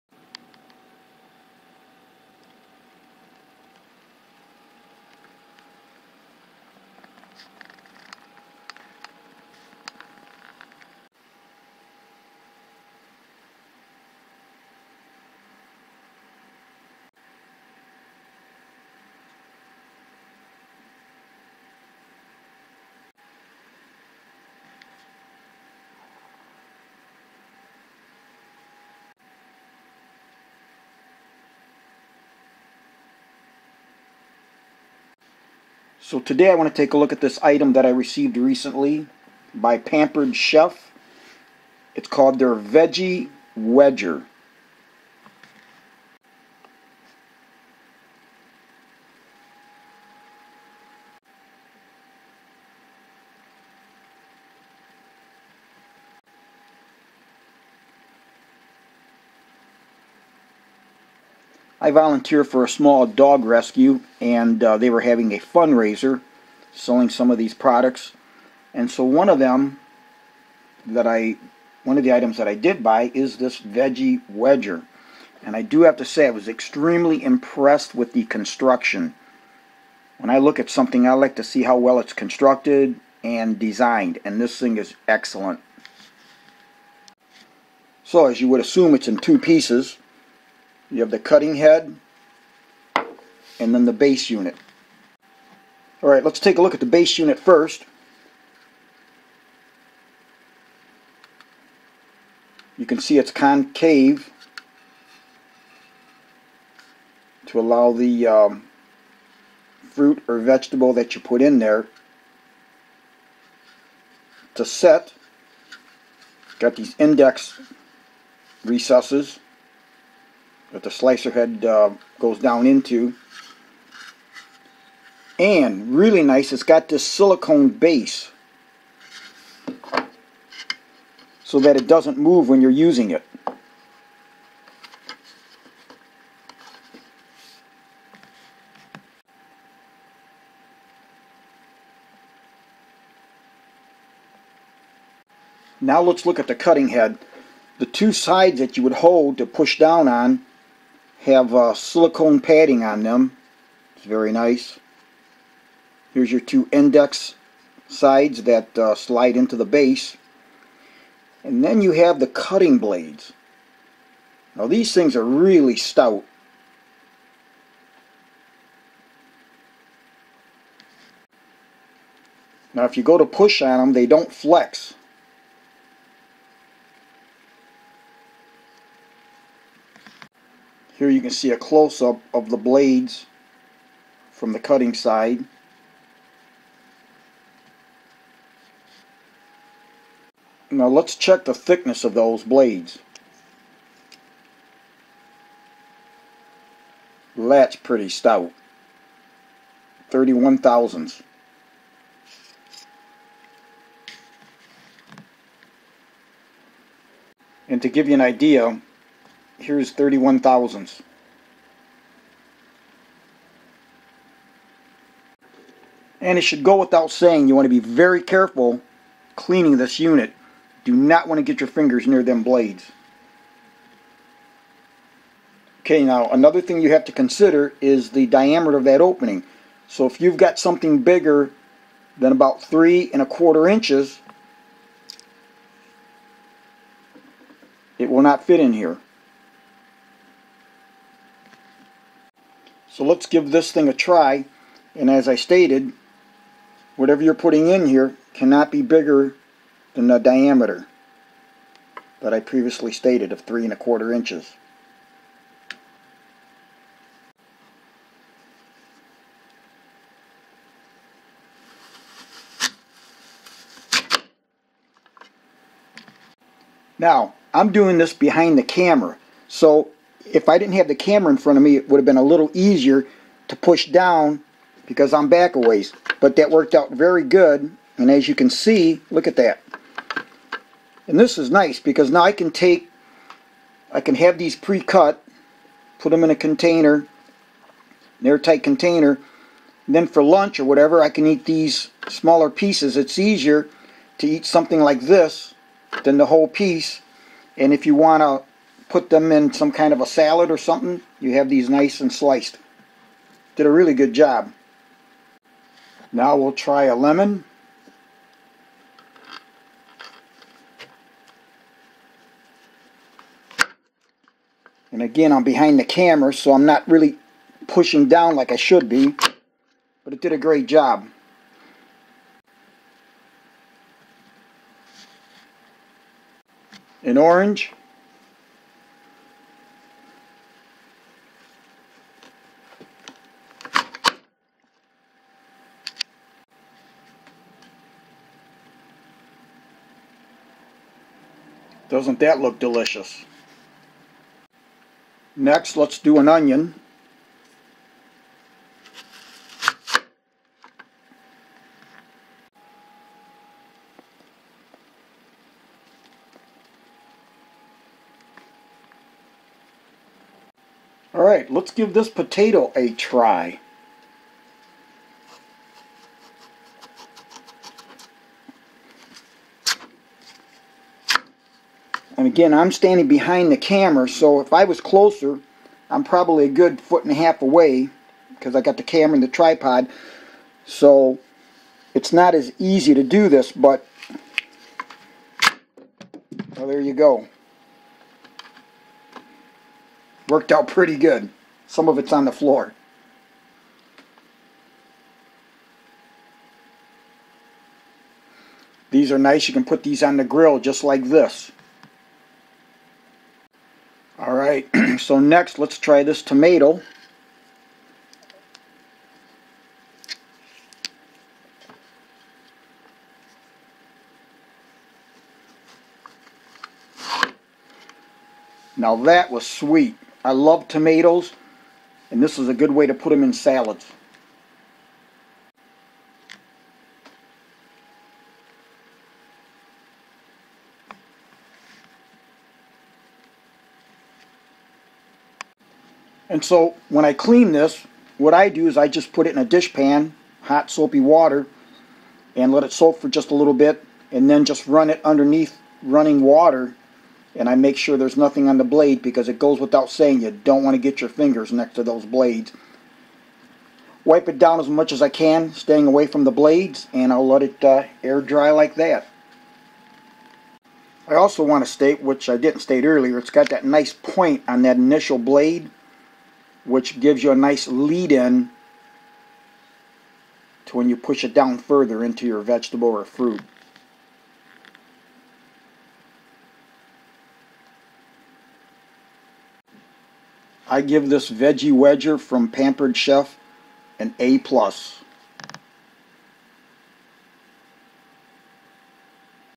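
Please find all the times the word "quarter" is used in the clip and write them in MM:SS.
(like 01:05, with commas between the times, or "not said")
03:53, 04:13.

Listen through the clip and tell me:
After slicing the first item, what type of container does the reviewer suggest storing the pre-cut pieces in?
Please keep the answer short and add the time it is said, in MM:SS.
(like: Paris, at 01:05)
airtight container, at 04:48.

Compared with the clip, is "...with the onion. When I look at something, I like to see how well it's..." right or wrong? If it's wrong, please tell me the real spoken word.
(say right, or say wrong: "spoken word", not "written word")
wrong: "construction", not "onion".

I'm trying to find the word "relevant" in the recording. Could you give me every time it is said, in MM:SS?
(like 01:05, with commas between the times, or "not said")
not said.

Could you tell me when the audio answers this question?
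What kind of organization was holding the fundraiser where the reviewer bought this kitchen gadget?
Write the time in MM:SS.
01:02.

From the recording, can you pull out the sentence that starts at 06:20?
So it's not as easy to do this, but well, there you go.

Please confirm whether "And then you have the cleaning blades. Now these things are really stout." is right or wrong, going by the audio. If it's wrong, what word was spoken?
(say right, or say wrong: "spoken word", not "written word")
wrong: "cutting", not "cleaning".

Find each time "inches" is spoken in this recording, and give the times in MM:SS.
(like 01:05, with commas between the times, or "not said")
03:53, 04:14.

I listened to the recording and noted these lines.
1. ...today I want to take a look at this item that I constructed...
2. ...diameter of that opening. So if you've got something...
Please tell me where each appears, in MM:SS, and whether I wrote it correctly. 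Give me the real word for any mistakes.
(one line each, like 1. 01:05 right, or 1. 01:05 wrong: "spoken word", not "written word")
1. 00:36 wrong: "received", not "constructed"
2. 03:48 right.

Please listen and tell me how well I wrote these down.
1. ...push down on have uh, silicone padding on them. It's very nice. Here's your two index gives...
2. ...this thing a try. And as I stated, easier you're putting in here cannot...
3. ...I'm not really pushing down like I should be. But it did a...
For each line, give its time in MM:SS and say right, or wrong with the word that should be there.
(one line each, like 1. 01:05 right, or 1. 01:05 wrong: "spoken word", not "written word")
1. 02:29 wrong: "sides", not "gives"
2. 04:03 wrong: "whatever", not "easier"
3. 05:16 right.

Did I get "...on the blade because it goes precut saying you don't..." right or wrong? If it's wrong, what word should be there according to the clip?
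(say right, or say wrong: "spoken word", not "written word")
wrong: "without", not "precut".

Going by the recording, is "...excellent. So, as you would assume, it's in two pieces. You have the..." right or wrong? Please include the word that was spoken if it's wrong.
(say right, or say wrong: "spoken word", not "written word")
right.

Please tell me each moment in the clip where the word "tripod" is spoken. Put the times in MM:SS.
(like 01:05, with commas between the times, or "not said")
06:19.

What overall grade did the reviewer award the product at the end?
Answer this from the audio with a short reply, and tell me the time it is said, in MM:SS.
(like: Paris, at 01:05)
A plus, at 08:03.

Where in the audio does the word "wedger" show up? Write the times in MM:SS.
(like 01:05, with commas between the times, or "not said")
00:43, 01:14, 08:01.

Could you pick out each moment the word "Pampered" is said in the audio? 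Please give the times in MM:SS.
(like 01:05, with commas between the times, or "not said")
00:39, 08:02.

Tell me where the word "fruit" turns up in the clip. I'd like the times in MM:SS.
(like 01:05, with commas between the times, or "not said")
01:49, 07:53.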